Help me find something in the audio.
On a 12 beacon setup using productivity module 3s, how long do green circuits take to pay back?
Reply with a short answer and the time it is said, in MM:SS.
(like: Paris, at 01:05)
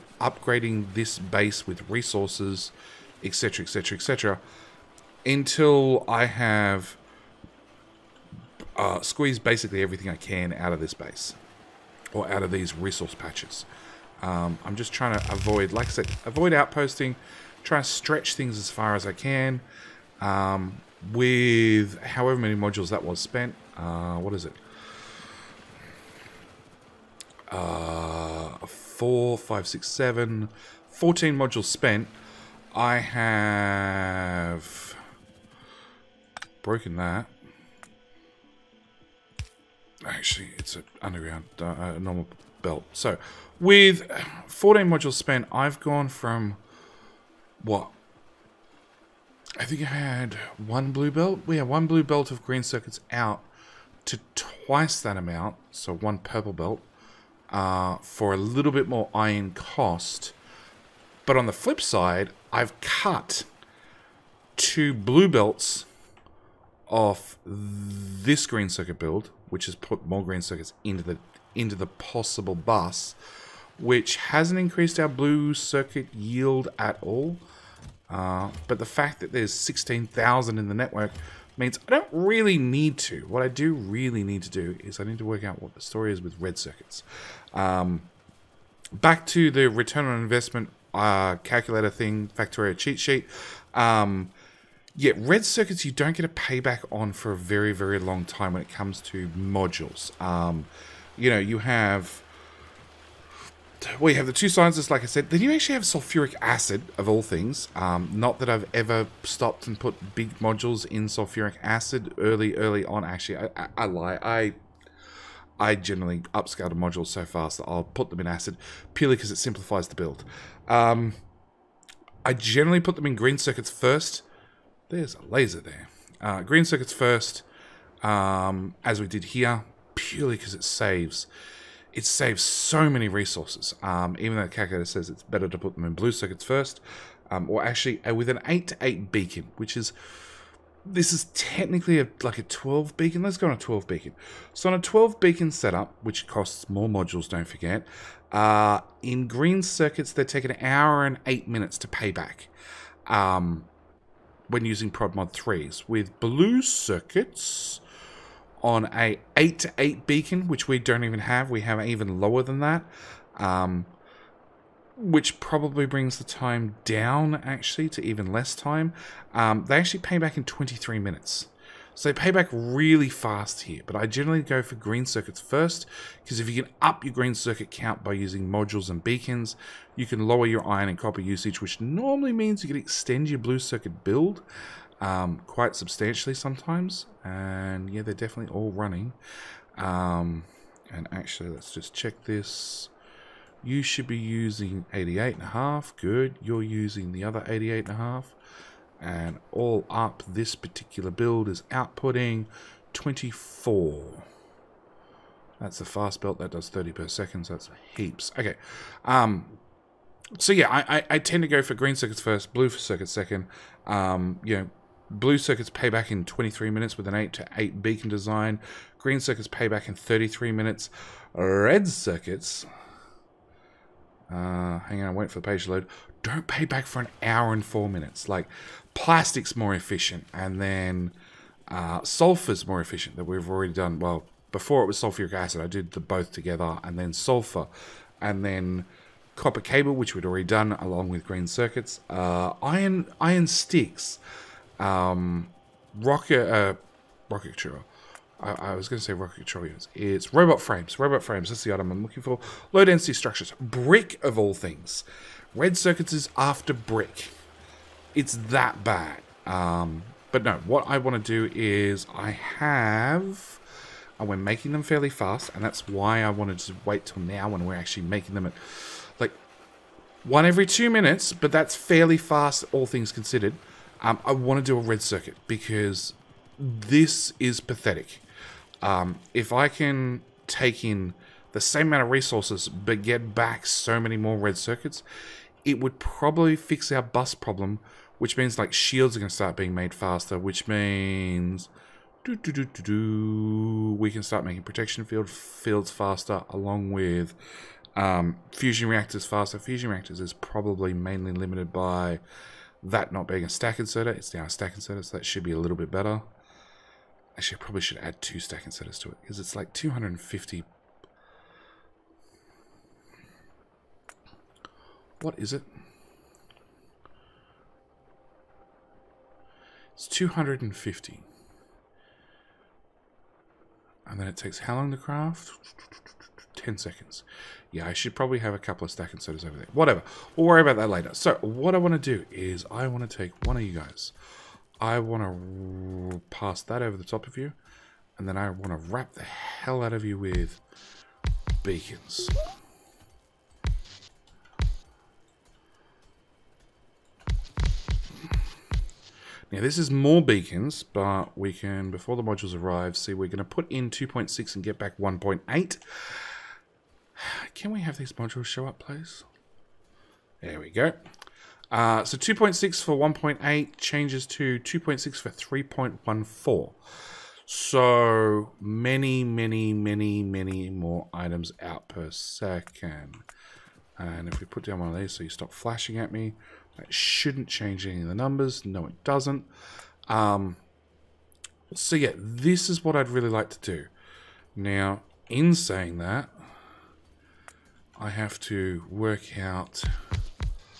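1 hour 8 minutes, at 02:30.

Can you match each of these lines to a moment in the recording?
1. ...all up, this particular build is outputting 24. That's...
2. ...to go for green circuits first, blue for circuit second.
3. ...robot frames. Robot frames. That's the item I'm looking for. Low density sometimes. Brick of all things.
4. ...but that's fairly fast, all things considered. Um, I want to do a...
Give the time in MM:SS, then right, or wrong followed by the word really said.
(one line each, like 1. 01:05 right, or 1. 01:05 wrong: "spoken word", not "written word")
1. 03:19 right
2. 03:31 right
3. 04:10 wrong: "structures", not "sometimes"
4. 04:31 right.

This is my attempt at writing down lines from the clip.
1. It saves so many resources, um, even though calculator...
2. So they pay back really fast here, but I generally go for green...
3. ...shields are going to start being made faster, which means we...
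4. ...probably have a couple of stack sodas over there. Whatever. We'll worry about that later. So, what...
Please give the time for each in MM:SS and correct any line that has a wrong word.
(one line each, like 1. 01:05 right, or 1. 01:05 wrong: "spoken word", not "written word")
1. 02:11 right
2. 02:51 right
3. 04:48 right
4. 05:28 right.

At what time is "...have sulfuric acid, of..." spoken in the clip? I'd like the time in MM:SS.
01:45.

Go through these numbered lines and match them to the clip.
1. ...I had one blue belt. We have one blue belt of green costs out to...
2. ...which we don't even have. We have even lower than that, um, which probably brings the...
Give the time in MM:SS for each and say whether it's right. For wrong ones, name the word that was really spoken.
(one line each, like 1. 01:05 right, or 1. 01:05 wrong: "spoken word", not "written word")
1. 00:49 wrong: "circuits", not "costs"
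2. 02:40 right.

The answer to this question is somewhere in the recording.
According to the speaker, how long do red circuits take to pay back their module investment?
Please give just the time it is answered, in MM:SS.
03:46.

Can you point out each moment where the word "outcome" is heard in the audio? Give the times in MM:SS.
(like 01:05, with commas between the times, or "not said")
not said.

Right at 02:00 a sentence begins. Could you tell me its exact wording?
Um, I generally put them in green circuits first.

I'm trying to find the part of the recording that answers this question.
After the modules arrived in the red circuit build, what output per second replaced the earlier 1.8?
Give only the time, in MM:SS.
06:05.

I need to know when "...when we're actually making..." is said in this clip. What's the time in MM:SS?
04:27.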